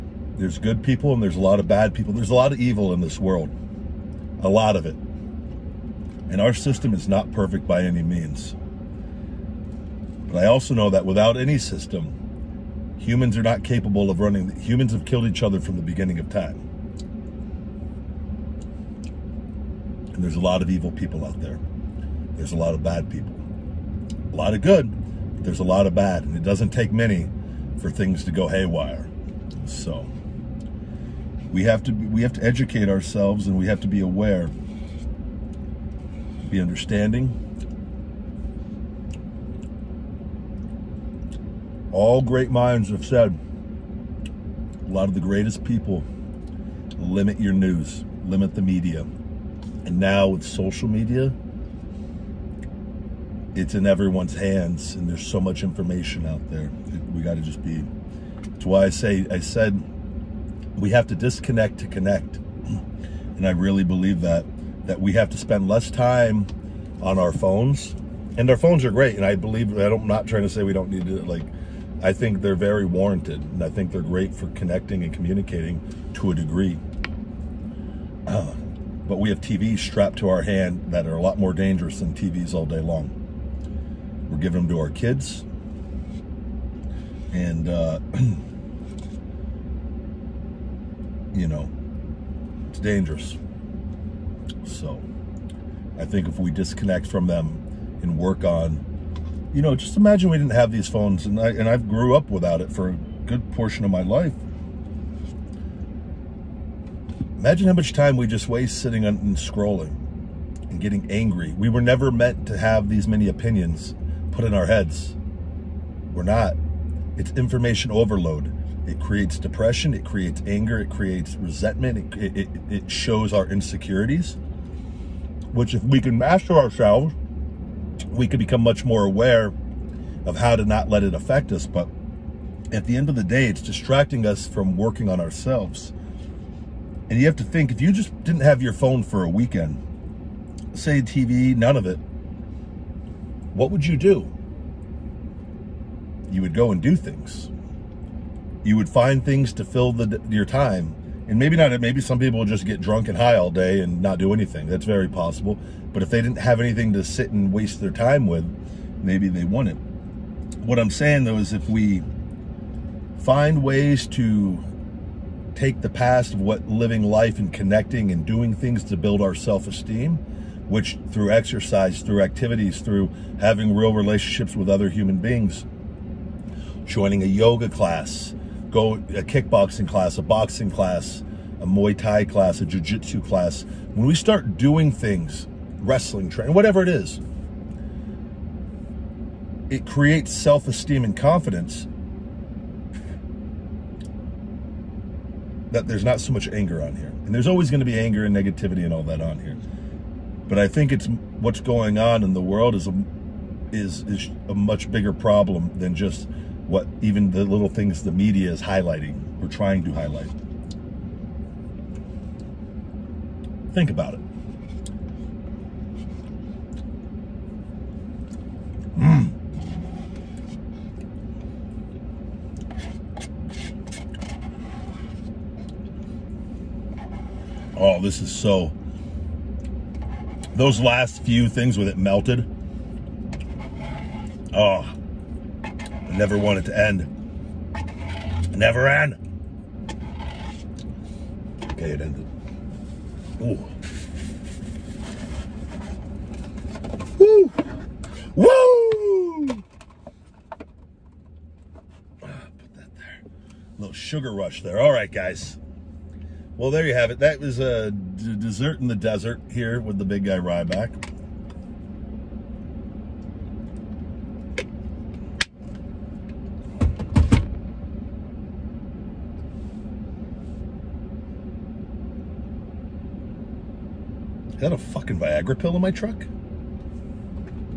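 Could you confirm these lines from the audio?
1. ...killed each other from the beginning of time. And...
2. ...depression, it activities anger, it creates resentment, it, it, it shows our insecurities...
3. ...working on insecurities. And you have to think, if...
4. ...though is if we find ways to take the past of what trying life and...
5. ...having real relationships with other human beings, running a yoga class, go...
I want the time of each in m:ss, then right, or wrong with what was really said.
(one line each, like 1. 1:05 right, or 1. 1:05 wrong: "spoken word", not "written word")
1. 0:15 right
2. 1:59 wrong: "creates", not "activities"
3. 2:14 wrong: "ourselves", not "insecurities"
4. 2:41 wrong: "living", not "trying"
5. 2:53 wrong: "joining", not "running".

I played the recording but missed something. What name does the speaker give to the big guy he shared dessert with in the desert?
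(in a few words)
Ryback.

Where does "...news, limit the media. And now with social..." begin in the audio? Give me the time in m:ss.
0:47.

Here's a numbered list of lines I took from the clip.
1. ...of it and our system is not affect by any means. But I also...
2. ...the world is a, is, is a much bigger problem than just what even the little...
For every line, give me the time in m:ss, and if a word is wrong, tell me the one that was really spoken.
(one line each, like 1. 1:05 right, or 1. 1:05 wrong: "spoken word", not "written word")
1. 0:04 wrong: "perfect", not "affect"
2. 3:22 right.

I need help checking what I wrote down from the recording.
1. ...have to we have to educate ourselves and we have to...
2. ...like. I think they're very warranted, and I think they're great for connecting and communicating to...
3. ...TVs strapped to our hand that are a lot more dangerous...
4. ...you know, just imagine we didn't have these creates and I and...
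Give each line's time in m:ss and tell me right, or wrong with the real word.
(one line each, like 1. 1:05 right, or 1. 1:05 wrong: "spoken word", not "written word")
1. 0:31 right
2. 1:11 right
3. 1:19 right
4. 1:39 wrong: "phones", not "creates".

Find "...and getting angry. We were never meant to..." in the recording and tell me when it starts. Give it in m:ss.
1:50.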